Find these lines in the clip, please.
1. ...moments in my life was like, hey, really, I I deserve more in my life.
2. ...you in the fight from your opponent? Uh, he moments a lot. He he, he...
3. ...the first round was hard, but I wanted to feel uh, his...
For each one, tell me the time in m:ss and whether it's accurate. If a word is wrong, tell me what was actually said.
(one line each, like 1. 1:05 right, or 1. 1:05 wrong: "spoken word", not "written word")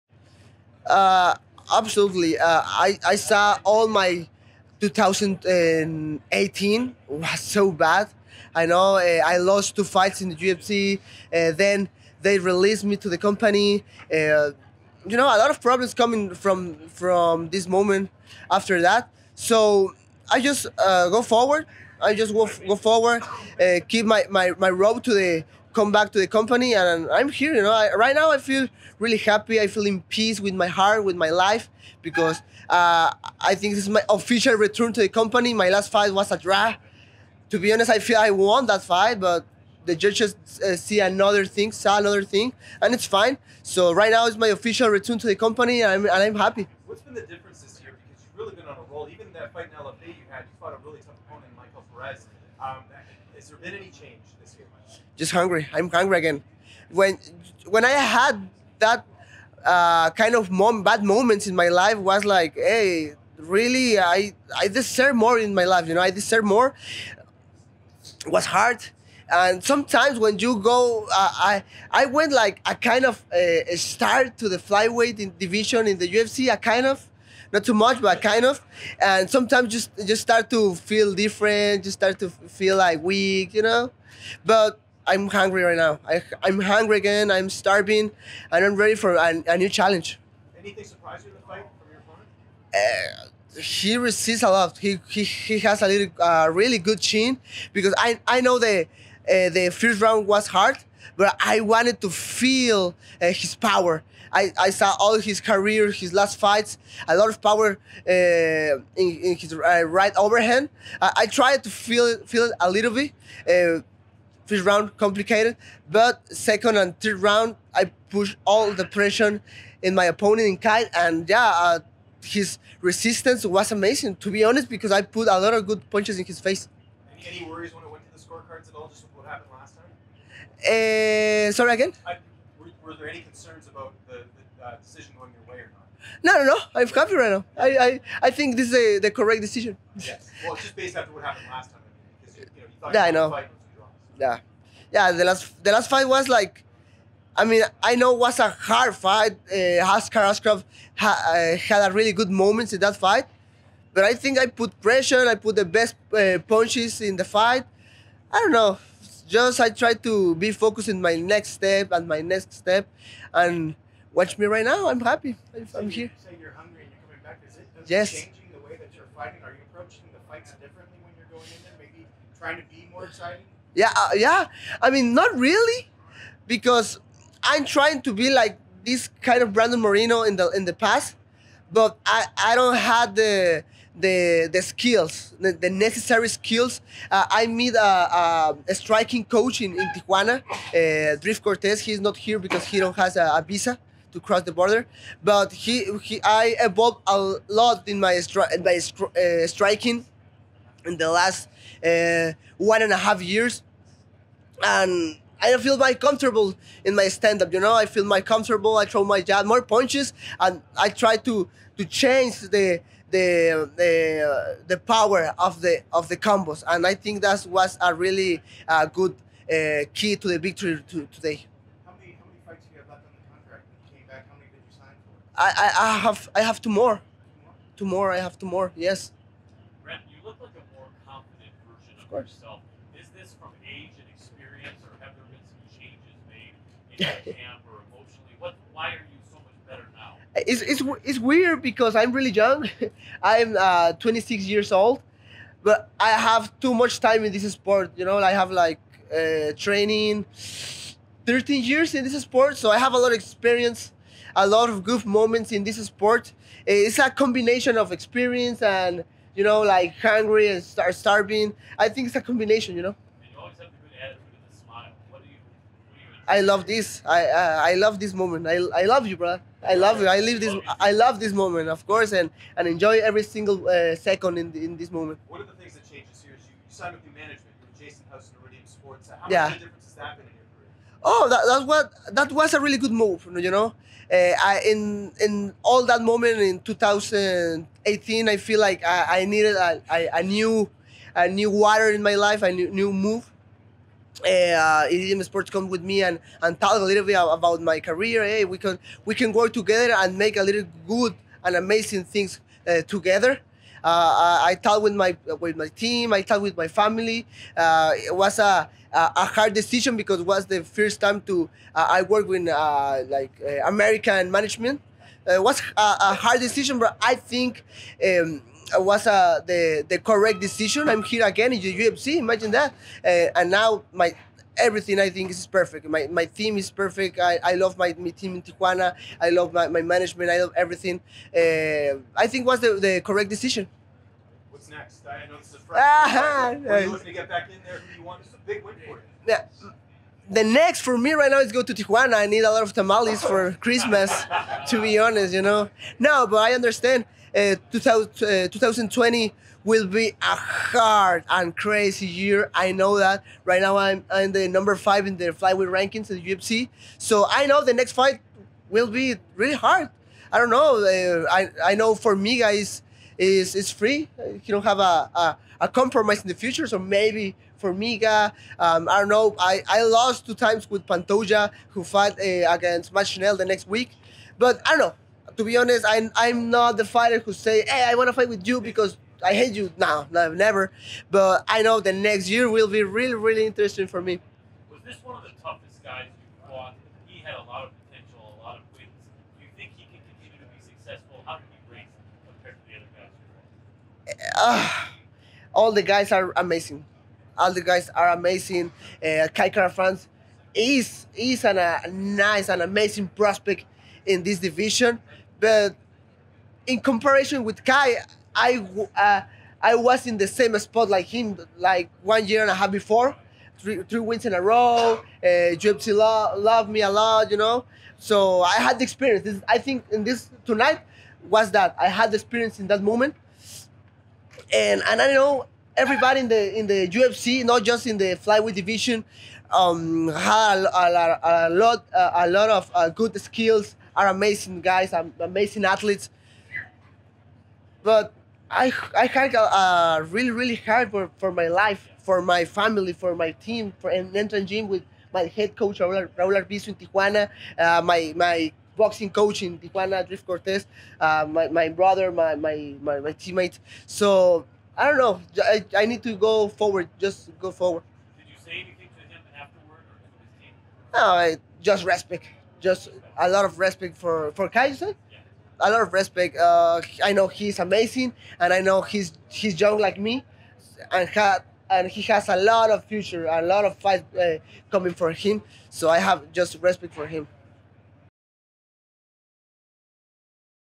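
1. 1:01 right
2. 1:31 wrong: "resists", not "moments"
3. 1:39 right.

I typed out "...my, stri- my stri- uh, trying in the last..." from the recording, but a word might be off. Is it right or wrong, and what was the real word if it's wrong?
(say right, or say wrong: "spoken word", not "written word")
wrong: "striking", not "trying".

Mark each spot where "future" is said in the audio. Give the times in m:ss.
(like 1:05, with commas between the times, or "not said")
6:06, 7:52.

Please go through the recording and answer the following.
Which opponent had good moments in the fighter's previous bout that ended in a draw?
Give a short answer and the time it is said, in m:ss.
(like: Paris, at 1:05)
Askar Askarov, at 2:29.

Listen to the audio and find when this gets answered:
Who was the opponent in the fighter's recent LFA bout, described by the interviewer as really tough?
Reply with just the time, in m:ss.
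0:51.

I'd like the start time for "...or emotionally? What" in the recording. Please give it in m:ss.
3:57.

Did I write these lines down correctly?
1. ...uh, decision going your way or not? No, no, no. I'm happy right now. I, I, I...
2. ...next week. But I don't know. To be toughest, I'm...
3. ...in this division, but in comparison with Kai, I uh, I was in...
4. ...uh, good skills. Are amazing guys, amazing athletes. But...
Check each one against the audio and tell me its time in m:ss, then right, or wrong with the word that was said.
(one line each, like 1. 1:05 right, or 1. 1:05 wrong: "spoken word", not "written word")
1. 2:14 right
2. 6:13 wrong: "honest", not "toughest"
3. 6:44 right
4. 7:12 right.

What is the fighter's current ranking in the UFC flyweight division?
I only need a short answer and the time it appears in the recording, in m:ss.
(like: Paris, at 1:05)
Number 5, at 5:54.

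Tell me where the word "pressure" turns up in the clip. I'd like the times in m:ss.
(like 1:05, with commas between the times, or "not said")
1:58, 2:34.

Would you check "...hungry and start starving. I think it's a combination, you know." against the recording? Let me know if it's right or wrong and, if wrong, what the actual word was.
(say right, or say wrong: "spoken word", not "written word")
right.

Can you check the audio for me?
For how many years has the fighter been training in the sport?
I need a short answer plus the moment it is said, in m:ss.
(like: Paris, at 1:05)
13, at 4:11.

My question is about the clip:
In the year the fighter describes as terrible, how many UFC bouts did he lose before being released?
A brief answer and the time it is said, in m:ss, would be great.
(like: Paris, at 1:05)
2, at 0:09.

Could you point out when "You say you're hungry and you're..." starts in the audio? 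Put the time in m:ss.
2:46.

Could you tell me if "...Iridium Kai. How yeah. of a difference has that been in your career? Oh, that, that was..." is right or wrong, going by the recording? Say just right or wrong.
wrong.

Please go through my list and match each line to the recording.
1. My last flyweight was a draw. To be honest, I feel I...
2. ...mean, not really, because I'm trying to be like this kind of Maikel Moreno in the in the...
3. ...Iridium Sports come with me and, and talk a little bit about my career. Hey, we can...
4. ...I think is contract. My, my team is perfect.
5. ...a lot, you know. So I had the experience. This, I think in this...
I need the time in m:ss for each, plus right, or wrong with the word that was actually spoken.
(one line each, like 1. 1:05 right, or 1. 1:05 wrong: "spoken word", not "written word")
1. 0:35 wrong: "fight", not "flyweight"
2. 2:54 wrong: "Brandon", not "Maikel"
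3. 4:54 right
4. 5:24 wrong: "perfect", not "contract"
5. 6:56 right.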